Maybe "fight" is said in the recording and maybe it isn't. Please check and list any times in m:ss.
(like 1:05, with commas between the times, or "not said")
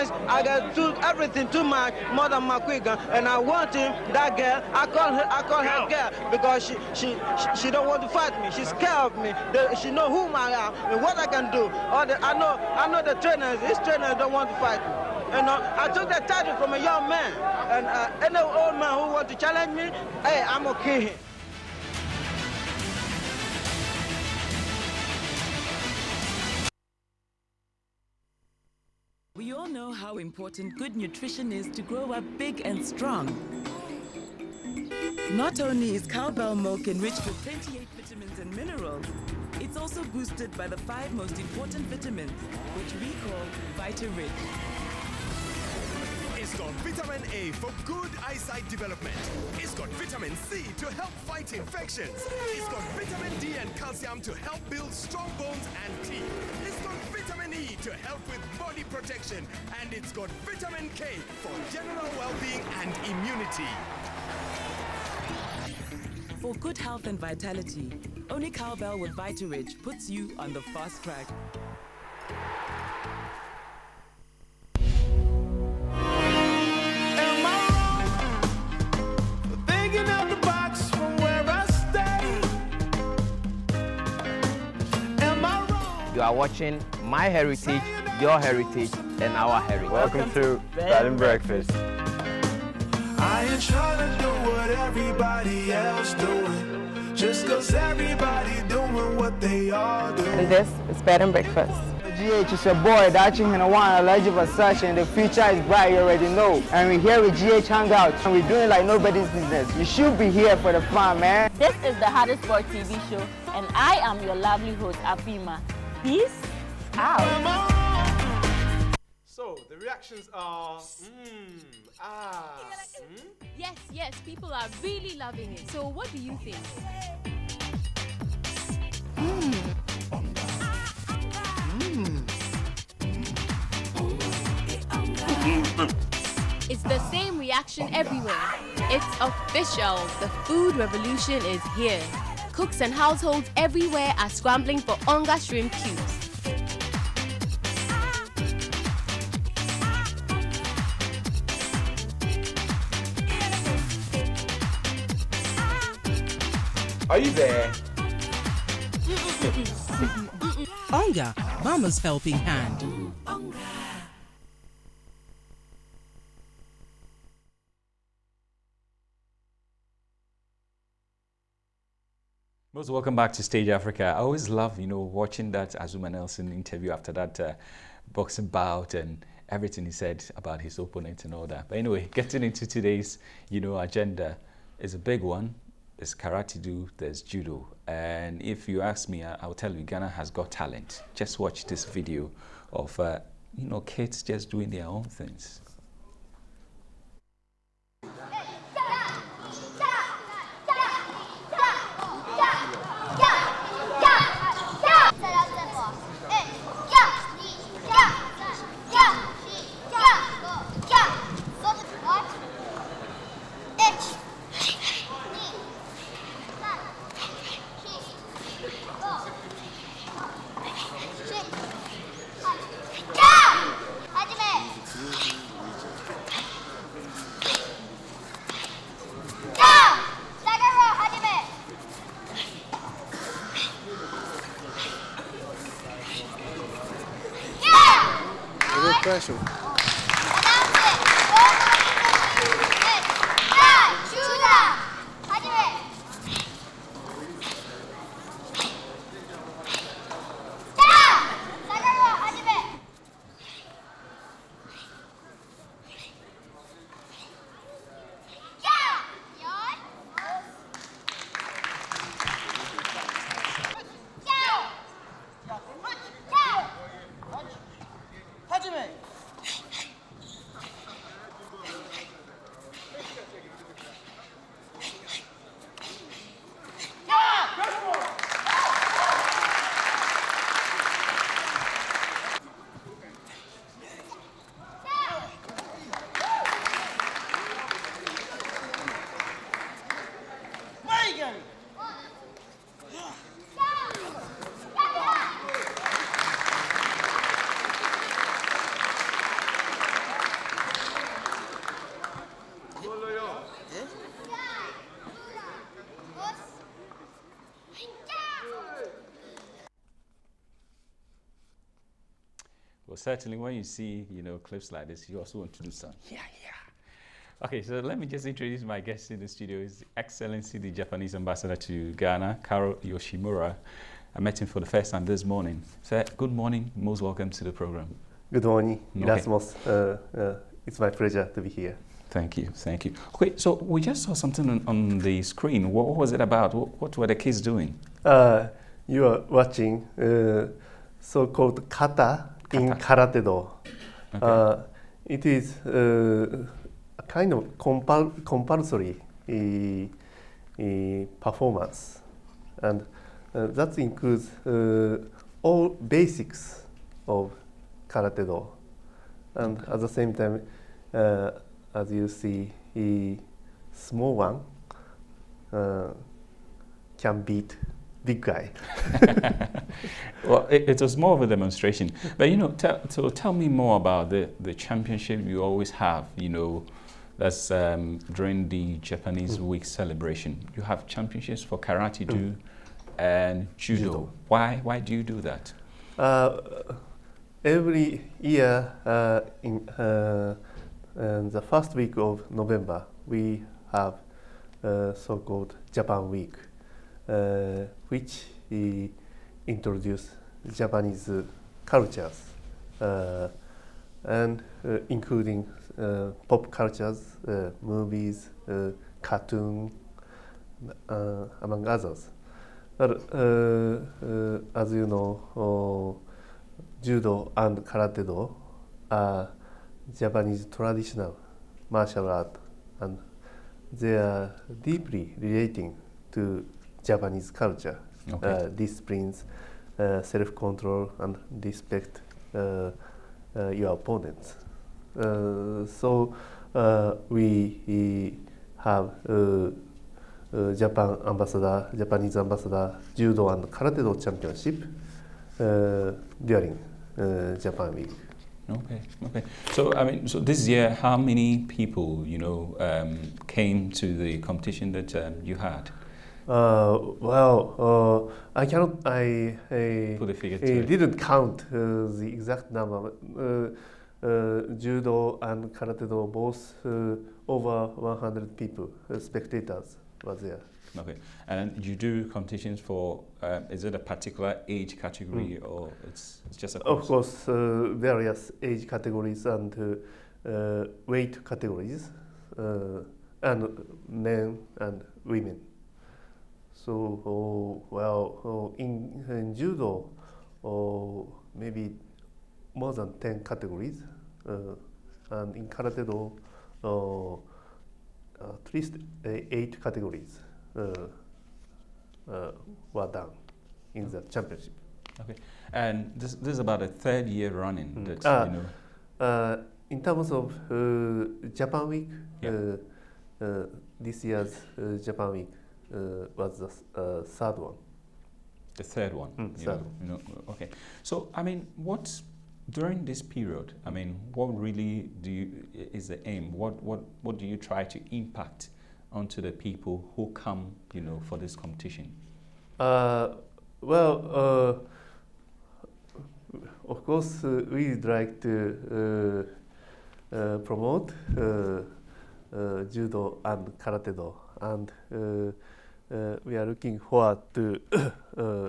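0:08, 0:14, 0:51.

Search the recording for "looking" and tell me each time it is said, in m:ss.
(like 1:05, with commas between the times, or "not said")
9:06.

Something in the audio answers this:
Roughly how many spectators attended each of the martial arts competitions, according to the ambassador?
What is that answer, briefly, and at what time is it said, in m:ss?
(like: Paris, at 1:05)
over 100, at 7:47.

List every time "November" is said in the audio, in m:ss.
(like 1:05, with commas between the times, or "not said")
6:32.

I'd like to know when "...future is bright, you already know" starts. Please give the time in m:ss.
1:45.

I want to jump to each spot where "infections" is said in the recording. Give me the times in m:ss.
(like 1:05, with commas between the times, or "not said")
0:51.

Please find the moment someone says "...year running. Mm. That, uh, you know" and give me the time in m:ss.
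8:27.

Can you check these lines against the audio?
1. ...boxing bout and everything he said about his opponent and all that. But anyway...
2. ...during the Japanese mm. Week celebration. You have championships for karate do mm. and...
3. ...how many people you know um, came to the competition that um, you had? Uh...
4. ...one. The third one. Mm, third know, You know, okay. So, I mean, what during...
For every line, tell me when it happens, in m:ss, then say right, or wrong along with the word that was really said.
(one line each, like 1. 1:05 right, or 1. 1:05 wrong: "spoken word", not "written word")
1. 2:58 right
2. 6:18 right
3. 7:30 right
4. 8:37 right.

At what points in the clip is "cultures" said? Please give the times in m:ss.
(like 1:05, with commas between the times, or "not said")
6:41, 6:46, 7:07.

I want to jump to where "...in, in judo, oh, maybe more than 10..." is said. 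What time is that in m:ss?
8:08.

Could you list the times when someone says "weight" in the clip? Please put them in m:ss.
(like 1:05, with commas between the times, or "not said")
8:00.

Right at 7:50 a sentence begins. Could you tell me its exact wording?
Okay, and you do competitions for.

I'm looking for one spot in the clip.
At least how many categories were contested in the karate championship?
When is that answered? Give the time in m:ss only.
8:19.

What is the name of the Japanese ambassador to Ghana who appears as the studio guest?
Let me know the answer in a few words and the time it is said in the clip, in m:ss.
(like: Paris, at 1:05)
Karou Yoshimura, at 5:22.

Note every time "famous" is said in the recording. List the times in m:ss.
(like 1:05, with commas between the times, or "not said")
not said.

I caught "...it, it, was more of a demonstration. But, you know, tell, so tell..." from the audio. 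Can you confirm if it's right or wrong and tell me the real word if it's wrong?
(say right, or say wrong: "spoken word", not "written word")
right.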